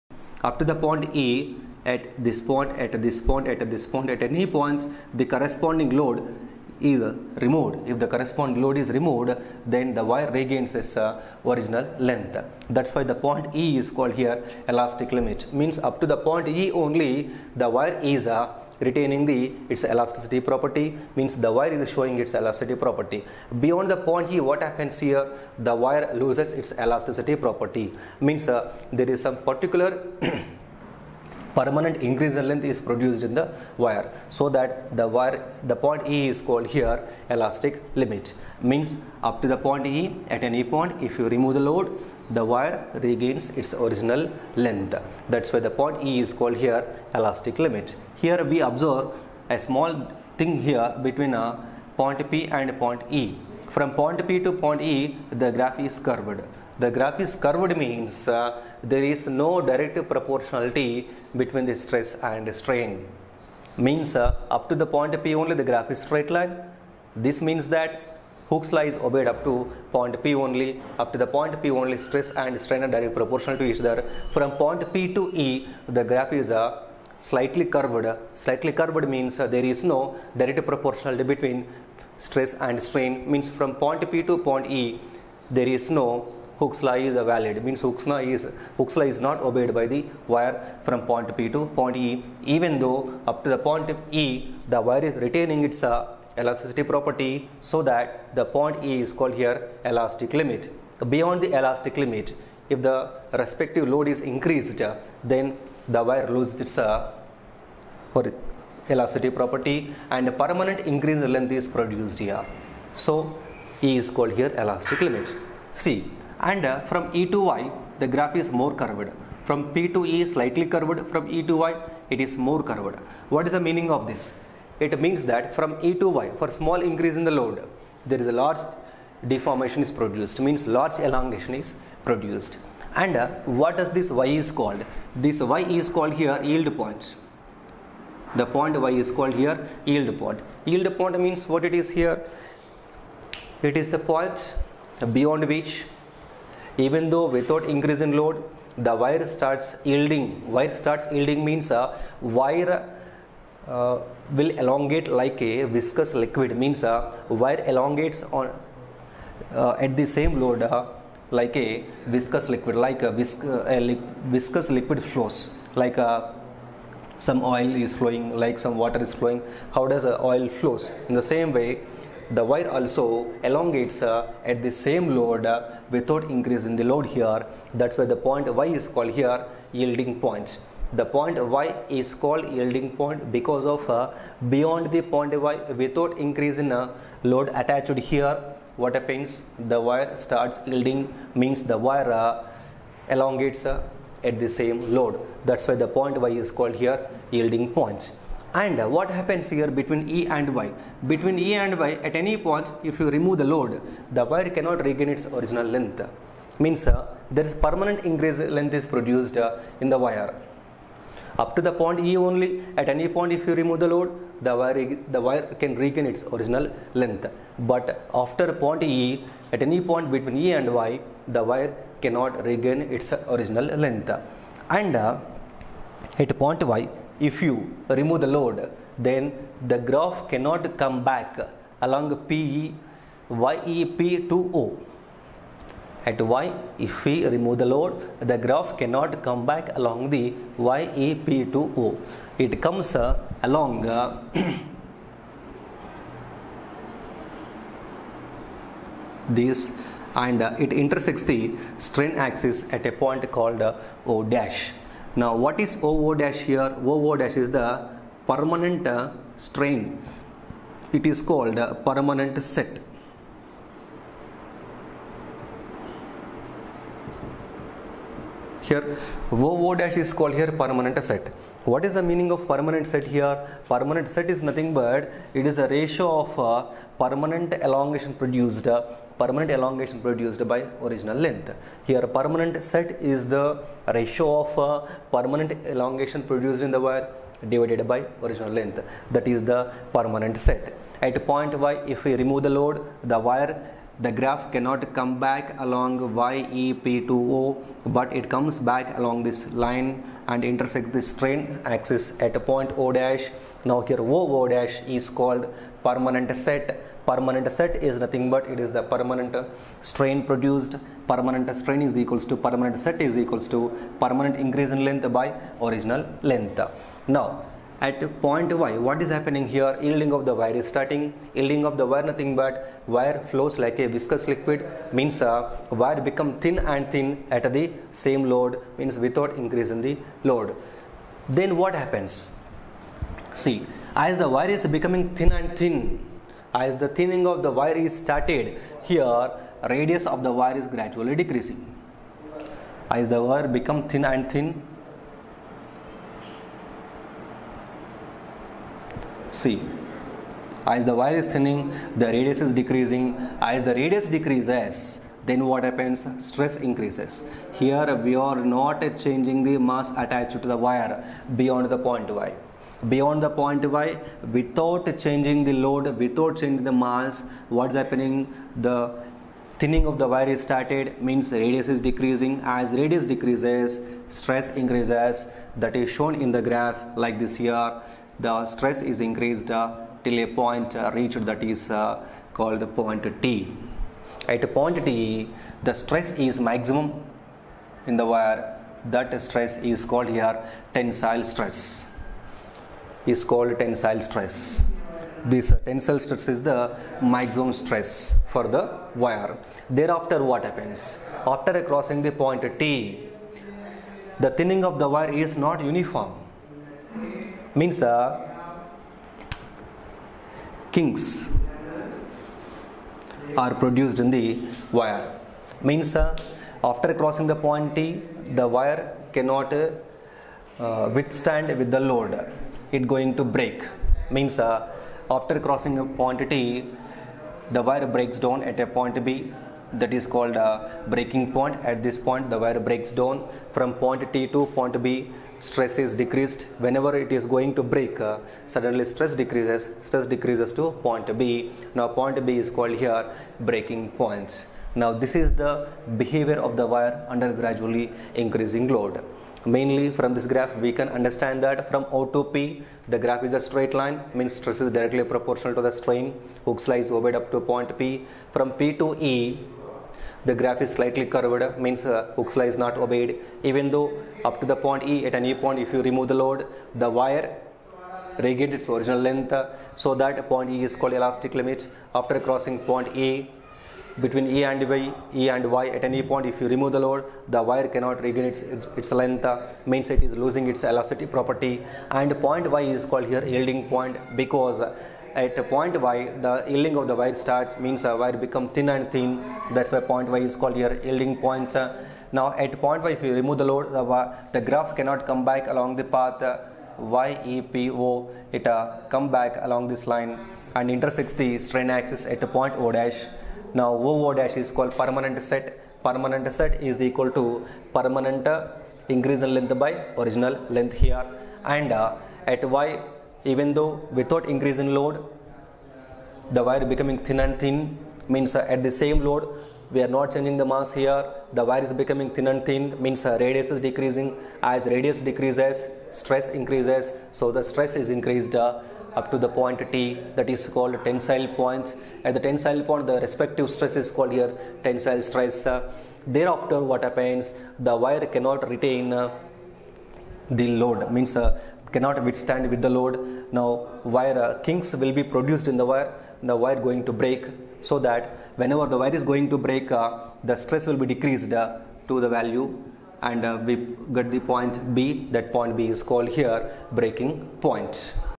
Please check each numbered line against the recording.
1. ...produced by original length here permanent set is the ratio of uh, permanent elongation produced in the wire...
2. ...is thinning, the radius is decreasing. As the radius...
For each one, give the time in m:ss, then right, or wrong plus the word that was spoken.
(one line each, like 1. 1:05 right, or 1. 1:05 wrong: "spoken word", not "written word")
1. 4:40 right
2. 5:51 right.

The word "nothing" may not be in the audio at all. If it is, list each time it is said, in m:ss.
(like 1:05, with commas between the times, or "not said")
4:34, 5:08, 5:22.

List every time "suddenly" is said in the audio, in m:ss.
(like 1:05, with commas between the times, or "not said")
7:18.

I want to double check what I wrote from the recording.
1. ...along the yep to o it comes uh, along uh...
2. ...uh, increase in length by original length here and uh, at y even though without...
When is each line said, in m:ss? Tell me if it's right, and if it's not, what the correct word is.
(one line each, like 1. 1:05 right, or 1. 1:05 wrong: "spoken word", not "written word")
1. 3:59 right
2. 8:28 right.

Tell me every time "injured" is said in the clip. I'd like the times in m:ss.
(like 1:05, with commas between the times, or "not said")
not said.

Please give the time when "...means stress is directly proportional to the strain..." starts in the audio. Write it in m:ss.
7:34.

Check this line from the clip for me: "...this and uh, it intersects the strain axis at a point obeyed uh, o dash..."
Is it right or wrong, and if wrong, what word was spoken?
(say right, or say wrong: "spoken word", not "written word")
wrong: "called", not "obeyed".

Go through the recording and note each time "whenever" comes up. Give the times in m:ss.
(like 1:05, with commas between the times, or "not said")
7:16, 9:08.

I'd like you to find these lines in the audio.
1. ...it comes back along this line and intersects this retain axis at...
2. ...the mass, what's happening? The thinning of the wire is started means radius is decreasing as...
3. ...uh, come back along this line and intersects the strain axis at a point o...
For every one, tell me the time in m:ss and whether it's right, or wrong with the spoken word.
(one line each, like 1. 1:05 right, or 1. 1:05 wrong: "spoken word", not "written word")
1. 4:58 wrong: "strain", not "retain"
2. 6:06 right
3. 8:18 right.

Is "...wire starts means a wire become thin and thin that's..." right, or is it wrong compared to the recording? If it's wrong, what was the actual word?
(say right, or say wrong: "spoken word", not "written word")
right.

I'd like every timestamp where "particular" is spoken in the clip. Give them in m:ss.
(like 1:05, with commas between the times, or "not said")
0:29.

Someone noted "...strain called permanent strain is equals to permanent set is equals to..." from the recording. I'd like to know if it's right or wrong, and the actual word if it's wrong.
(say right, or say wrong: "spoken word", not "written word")
wrong: "produced", not "called".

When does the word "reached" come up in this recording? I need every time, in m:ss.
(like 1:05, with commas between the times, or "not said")
6:20.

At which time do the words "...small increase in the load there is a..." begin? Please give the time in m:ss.
2:06.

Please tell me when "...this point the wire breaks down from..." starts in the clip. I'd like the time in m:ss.
7:11.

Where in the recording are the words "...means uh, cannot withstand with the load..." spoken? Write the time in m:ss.
9:00.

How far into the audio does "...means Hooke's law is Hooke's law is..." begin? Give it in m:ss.
1:27.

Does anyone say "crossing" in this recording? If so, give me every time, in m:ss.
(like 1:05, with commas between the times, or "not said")
6:41, 6:56, 7:05, 7:52.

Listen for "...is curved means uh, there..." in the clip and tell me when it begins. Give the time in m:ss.
0:57.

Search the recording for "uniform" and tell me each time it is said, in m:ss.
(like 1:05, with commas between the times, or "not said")
6:45.